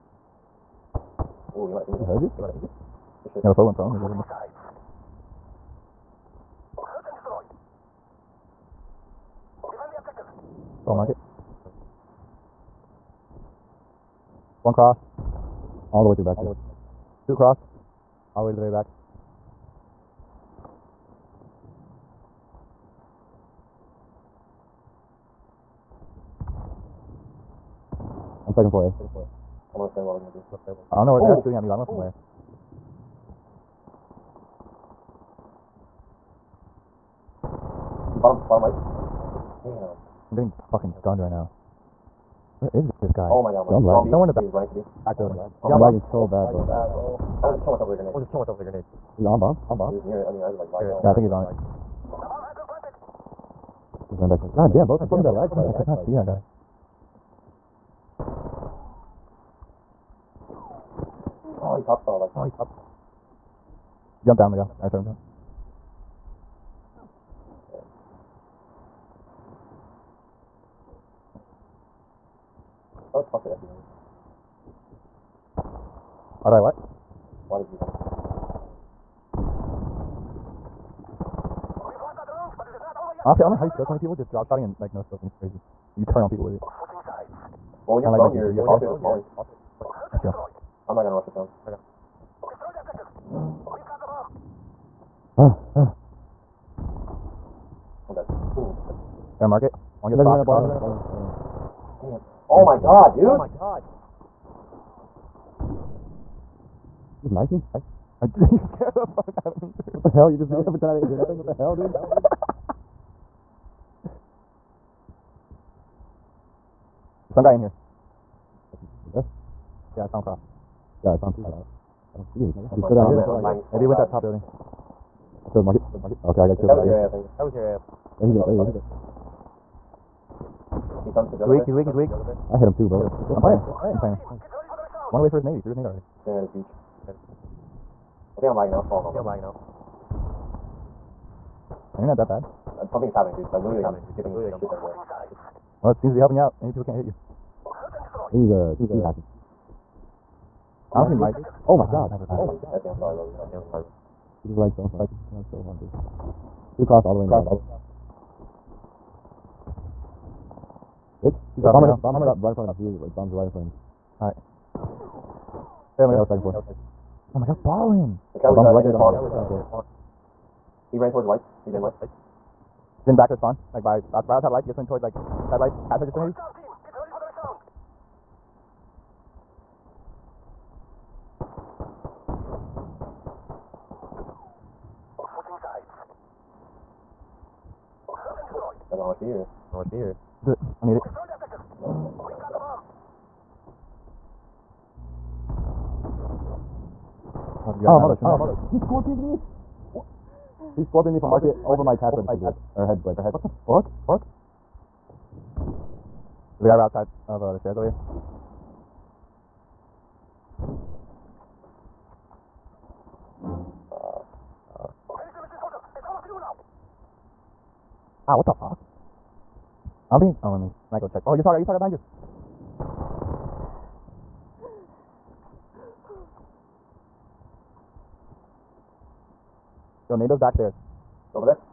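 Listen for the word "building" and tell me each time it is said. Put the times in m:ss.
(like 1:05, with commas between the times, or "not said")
0:45, 2:04.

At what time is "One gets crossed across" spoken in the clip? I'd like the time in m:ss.
1:40.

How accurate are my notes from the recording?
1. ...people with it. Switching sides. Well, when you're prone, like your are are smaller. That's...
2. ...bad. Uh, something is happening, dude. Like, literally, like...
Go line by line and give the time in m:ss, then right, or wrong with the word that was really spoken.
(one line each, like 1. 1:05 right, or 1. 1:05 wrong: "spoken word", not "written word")
1. 1:26 right
2. 2:22 right.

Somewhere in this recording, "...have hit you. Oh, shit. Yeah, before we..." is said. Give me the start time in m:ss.
0:02.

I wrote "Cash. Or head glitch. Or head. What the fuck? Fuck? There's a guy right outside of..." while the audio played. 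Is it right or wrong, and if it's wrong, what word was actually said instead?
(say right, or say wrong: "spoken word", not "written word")
right.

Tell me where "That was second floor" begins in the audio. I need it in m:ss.
2:46.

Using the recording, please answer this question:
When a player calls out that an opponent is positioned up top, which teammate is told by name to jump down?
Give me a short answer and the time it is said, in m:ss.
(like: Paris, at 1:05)
Miguel, at 1:04.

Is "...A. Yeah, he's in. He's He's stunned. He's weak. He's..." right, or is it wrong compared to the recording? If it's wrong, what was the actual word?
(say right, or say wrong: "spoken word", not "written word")
right.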